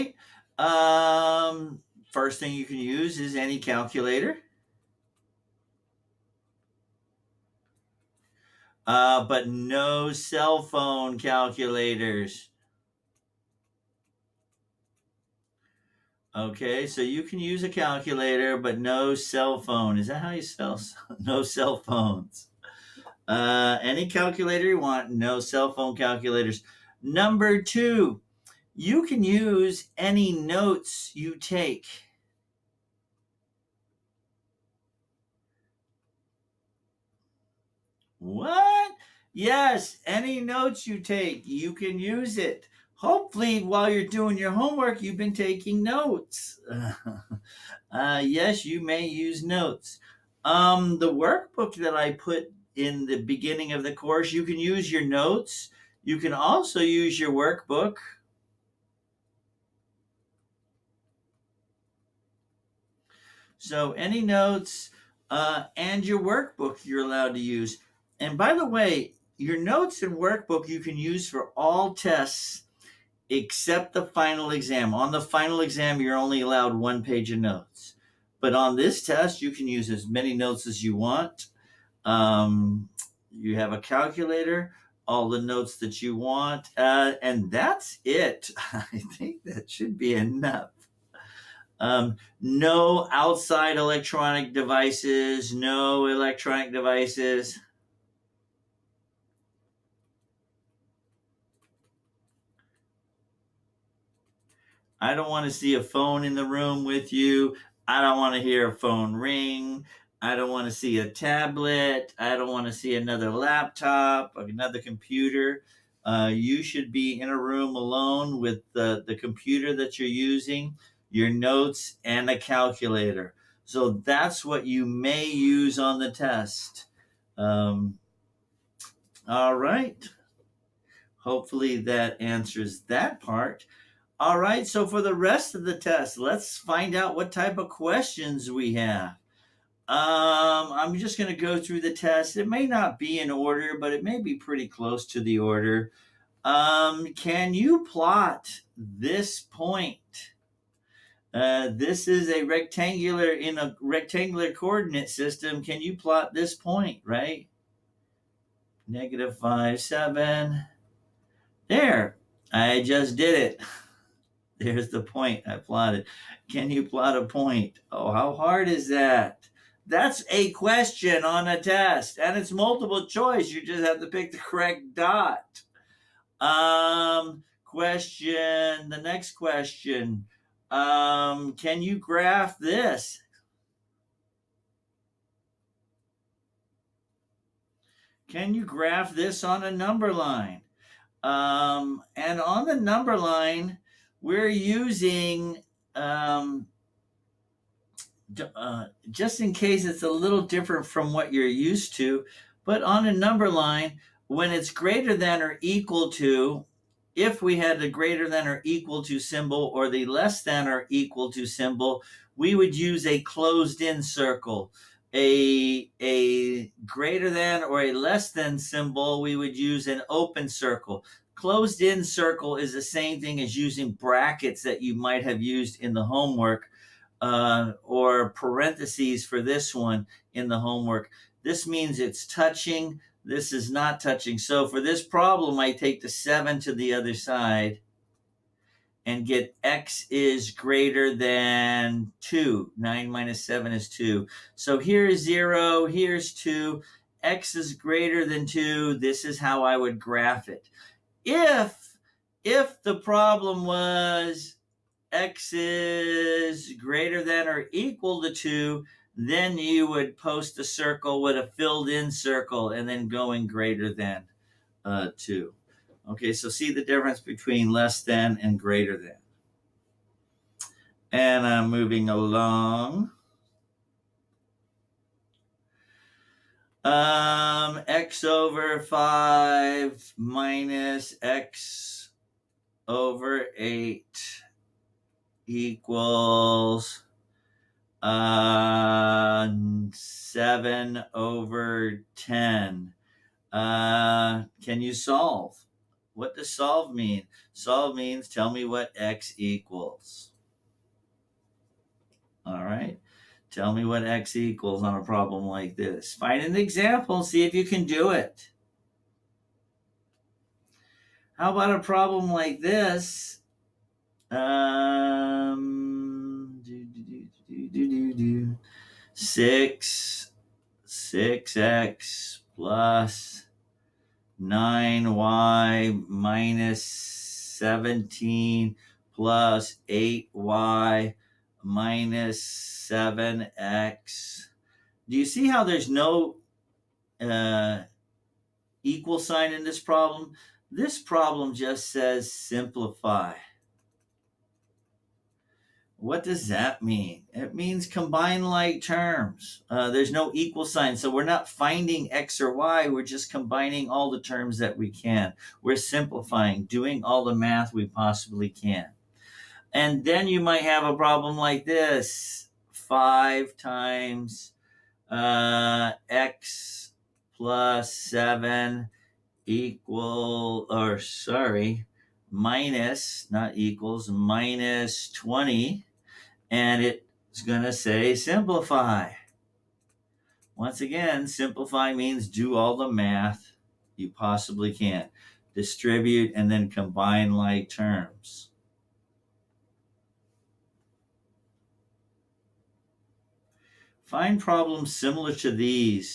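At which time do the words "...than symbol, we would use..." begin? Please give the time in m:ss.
3:38.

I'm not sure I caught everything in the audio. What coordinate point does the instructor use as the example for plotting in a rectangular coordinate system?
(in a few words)
-5, 7.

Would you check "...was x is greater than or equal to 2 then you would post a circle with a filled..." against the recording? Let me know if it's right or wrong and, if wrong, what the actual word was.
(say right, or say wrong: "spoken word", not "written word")
right.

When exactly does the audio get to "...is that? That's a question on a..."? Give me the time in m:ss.
2:48.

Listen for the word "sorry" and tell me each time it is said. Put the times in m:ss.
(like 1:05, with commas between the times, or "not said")
6:10.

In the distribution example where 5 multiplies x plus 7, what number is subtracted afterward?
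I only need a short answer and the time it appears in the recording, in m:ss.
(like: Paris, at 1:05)
20, at 6:15.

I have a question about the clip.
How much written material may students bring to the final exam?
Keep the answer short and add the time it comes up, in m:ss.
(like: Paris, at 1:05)
one page of notes, at 1:16.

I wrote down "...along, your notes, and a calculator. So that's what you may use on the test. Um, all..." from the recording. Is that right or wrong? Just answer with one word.
wrong.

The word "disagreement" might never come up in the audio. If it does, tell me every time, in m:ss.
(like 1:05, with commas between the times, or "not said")
not said.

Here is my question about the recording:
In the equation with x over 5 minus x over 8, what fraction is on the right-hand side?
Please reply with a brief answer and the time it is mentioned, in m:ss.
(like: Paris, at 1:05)
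7/10, at 4:49.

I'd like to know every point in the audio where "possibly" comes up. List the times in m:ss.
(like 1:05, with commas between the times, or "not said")
5:57, 6:24.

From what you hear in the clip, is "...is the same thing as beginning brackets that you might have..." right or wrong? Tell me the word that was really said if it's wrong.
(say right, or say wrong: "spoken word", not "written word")
wrong: "using", not "beginning".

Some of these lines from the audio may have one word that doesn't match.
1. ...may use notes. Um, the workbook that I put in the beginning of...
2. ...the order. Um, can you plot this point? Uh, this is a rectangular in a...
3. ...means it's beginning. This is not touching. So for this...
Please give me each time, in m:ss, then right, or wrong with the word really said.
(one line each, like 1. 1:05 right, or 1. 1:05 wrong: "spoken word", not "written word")
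1. 0:48 right
2. 2:25 right
3. 3:51 wrong: "touching", not "beginning".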